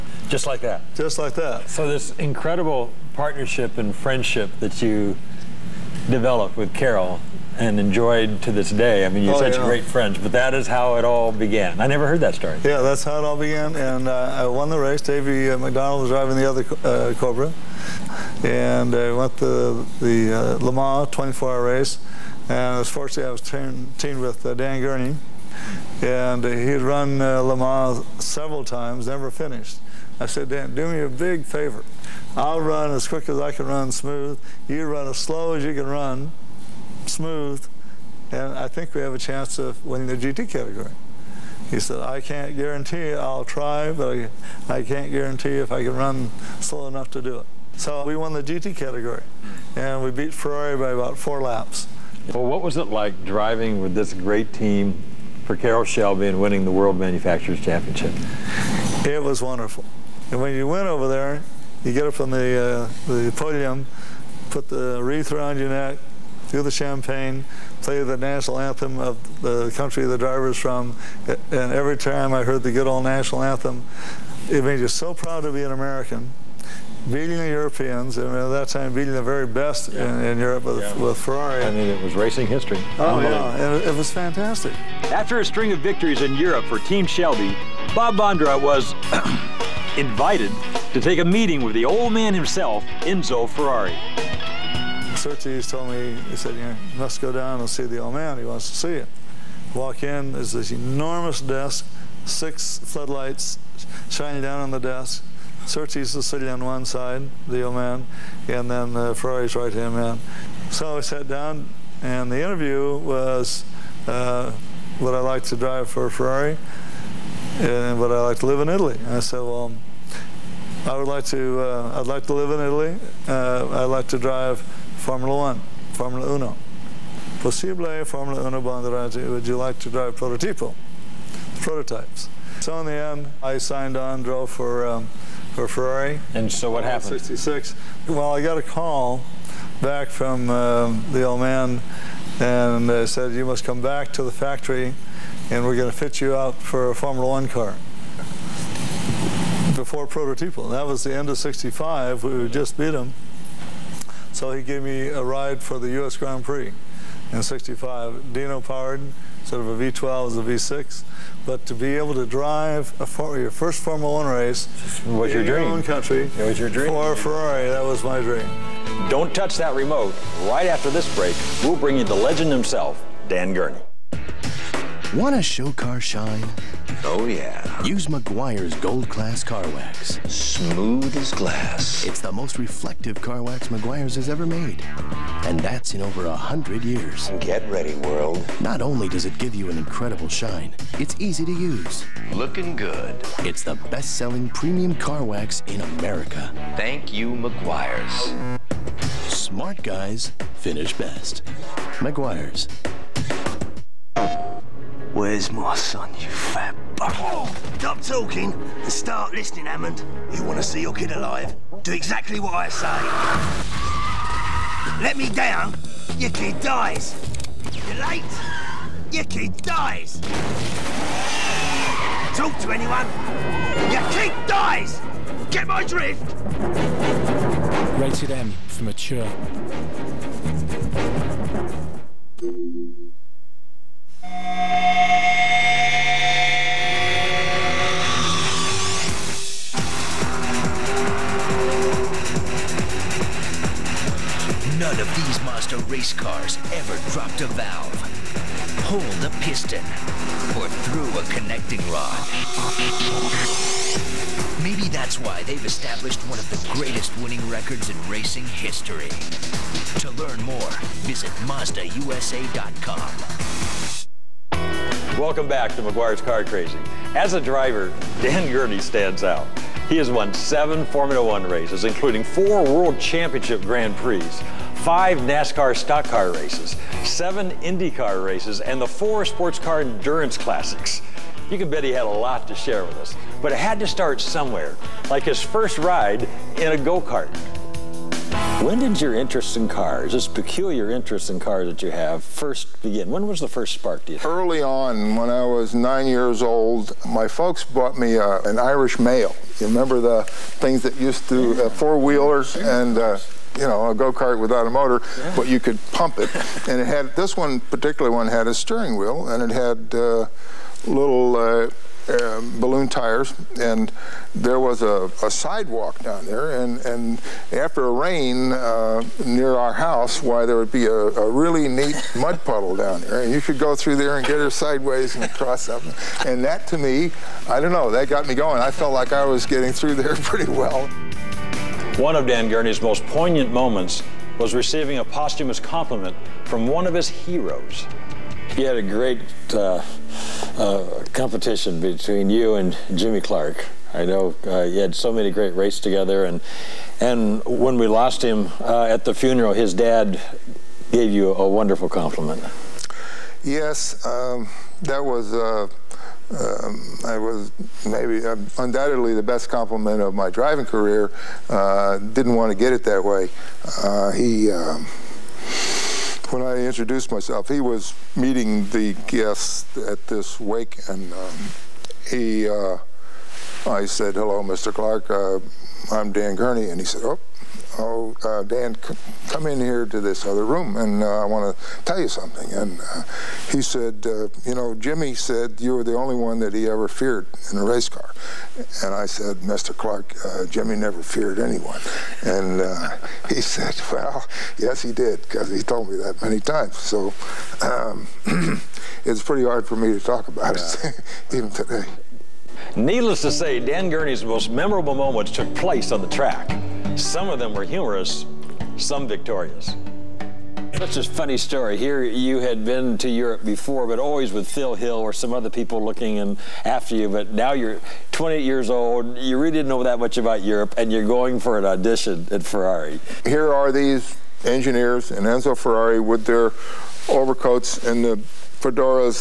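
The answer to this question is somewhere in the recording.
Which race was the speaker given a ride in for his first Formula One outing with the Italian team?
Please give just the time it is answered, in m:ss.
2:35.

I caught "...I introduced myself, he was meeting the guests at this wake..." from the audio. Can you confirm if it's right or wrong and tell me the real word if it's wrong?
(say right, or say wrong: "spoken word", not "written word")
right.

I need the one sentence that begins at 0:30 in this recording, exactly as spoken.
I said, Dan, do me a big favor.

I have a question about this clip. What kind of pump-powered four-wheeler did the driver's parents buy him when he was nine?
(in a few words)
Irish mail.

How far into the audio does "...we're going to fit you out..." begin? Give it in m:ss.
2:25.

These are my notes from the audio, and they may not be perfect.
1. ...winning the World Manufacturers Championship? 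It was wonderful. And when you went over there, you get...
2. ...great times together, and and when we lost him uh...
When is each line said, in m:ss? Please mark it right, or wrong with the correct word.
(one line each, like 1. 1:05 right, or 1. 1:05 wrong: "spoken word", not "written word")
1. 0:56 right
2. 5:45 wrong: "races", not "times".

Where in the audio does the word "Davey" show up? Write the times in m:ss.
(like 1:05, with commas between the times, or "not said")
0:15.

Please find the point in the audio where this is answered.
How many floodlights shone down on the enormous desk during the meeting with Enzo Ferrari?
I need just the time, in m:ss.
1:42.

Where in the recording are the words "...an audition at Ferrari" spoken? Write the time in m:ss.
7:01.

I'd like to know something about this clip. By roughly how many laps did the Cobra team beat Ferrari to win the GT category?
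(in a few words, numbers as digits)
4 laps.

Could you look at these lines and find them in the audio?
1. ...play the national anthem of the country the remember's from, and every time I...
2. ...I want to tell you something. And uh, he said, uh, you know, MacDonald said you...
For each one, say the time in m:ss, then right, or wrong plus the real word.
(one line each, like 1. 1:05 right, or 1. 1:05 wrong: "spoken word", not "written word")
1. 1:07 wrong: "driver", not "remember"
2. 6:21 wrong: "Jimmy", not "MacDonald".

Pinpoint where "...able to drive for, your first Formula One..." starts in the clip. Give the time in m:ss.
2:41.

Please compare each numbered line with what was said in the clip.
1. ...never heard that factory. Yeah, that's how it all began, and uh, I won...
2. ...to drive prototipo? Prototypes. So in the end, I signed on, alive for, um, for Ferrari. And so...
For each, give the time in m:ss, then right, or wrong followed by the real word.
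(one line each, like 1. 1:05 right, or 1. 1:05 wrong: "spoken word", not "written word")
1. 0:11 wrong: "story", not "factory"
2. 2:09 wrong: "drove", not "alive".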